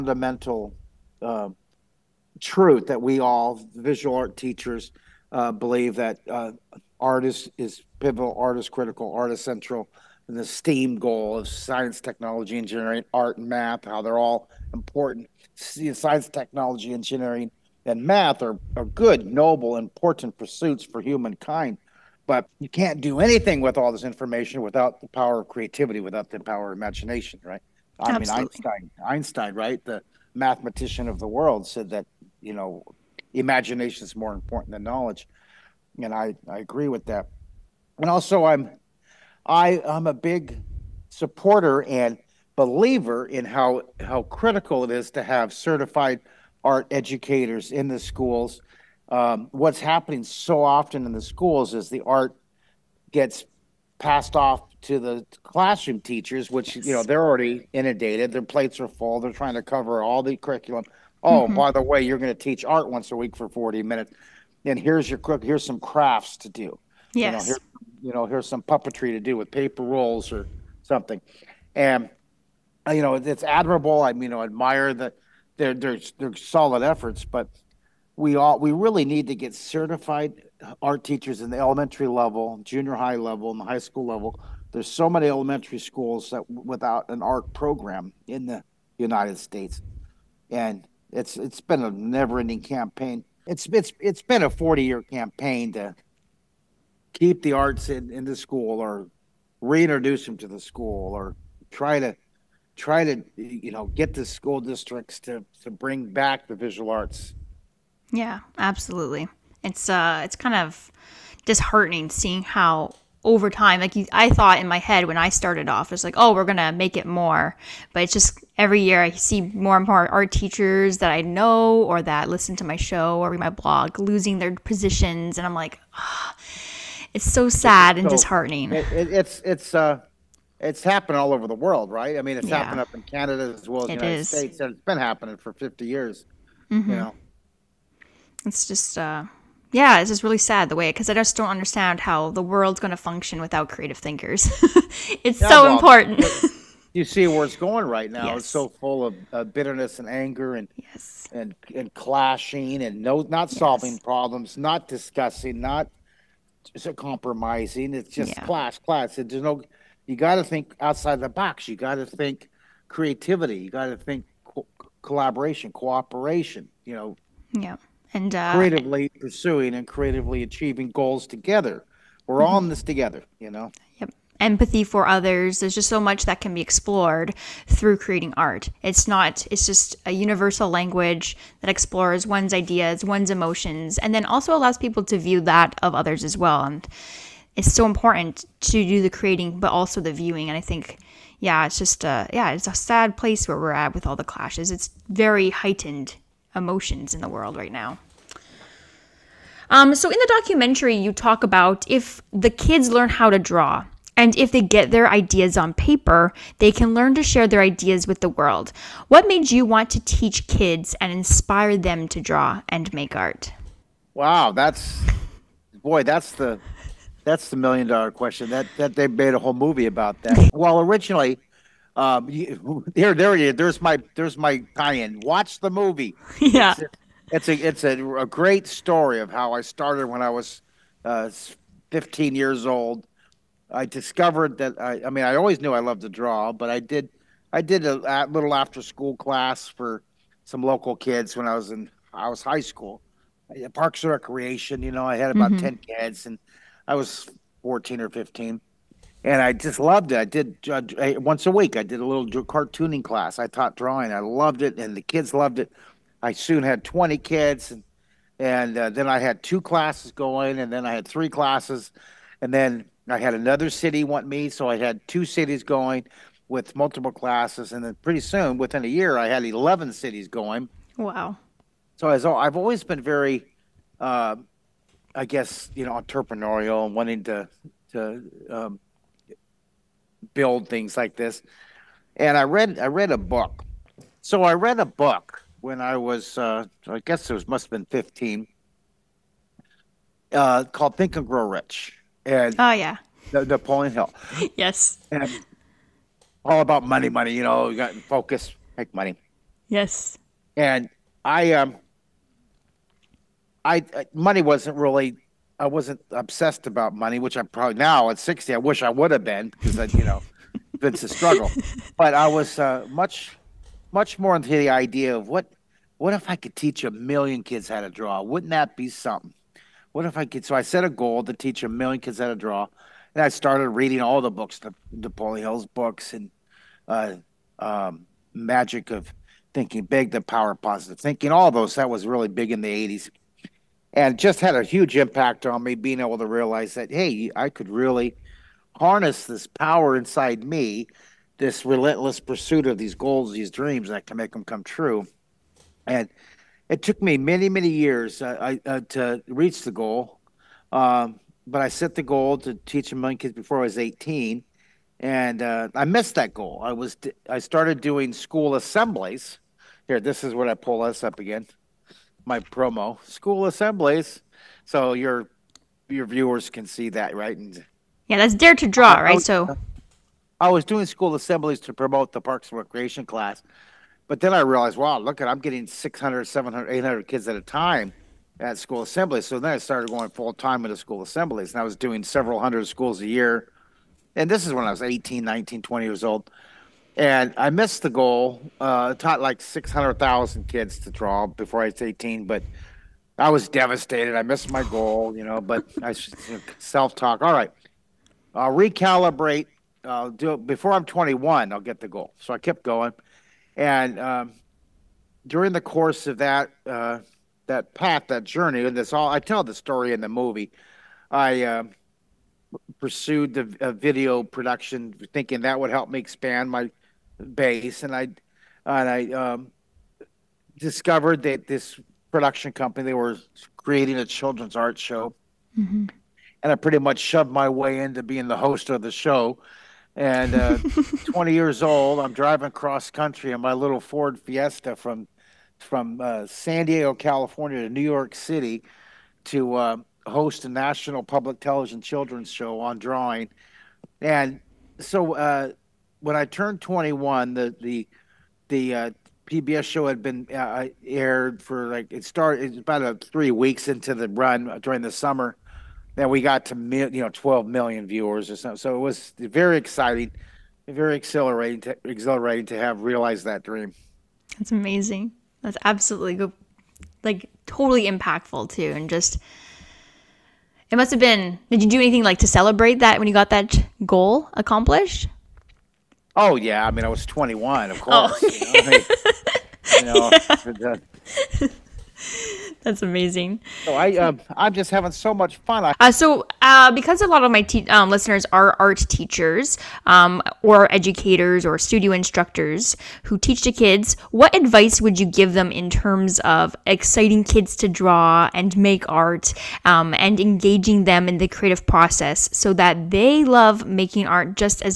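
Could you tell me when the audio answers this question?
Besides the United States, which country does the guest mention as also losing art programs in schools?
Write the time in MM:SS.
02:13.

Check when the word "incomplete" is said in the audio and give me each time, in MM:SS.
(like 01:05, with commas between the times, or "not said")
not said.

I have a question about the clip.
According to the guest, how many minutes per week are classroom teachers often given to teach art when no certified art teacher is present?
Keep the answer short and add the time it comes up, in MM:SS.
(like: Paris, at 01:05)
40, at 01:03.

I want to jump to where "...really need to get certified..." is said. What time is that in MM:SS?
01:18.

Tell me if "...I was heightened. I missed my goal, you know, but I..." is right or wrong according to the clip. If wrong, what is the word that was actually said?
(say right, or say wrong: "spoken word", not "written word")
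wrong: "devastated", not "heightened".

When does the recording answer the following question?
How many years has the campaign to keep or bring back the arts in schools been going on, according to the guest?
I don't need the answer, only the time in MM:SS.
01:34.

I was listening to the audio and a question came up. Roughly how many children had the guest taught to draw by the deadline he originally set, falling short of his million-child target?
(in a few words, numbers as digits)
600,000.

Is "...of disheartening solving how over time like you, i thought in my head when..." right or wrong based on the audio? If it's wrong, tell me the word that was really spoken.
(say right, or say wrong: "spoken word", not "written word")
wrong: "seeing", not "solving".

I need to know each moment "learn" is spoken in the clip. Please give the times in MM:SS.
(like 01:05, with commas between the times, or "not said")
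03:22, 03:26.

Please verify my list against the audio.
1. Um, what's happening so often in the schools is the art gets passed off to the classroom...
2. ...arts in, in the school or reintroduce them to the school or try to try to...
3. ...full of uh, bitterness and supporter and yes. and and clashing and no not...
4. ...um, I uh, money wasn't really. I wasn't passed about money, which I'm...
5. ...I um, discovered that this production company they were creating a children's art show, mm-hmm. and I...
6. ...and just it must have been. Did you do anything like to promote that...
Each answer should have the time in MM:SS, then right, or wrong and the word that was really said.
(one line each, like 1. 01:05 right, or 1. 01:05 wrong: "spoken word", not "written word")
1. 00:49 right
2. 01:37 right
3. 02:28 wrong: "anger", not "supporter"
4. 05:01 wrong: "obsessed", not "passed"
5. 06:58 right
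6. 07:48 wrong: "celebrate", not "promote".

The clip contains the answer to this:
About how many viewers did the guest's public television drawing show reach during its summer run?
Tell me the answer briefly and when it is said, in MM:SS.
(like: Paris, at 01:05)
12 million, at 07:37.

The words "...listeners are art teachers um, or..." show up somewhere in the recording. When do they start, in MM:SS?
08:07.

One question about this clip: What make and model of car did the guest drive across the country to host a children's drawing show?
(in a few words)
Ford Fiesta.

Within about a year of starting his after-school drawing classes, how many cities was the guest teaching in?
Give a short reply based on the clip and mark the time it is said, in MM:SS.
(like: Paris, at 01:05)
11, at 04:29.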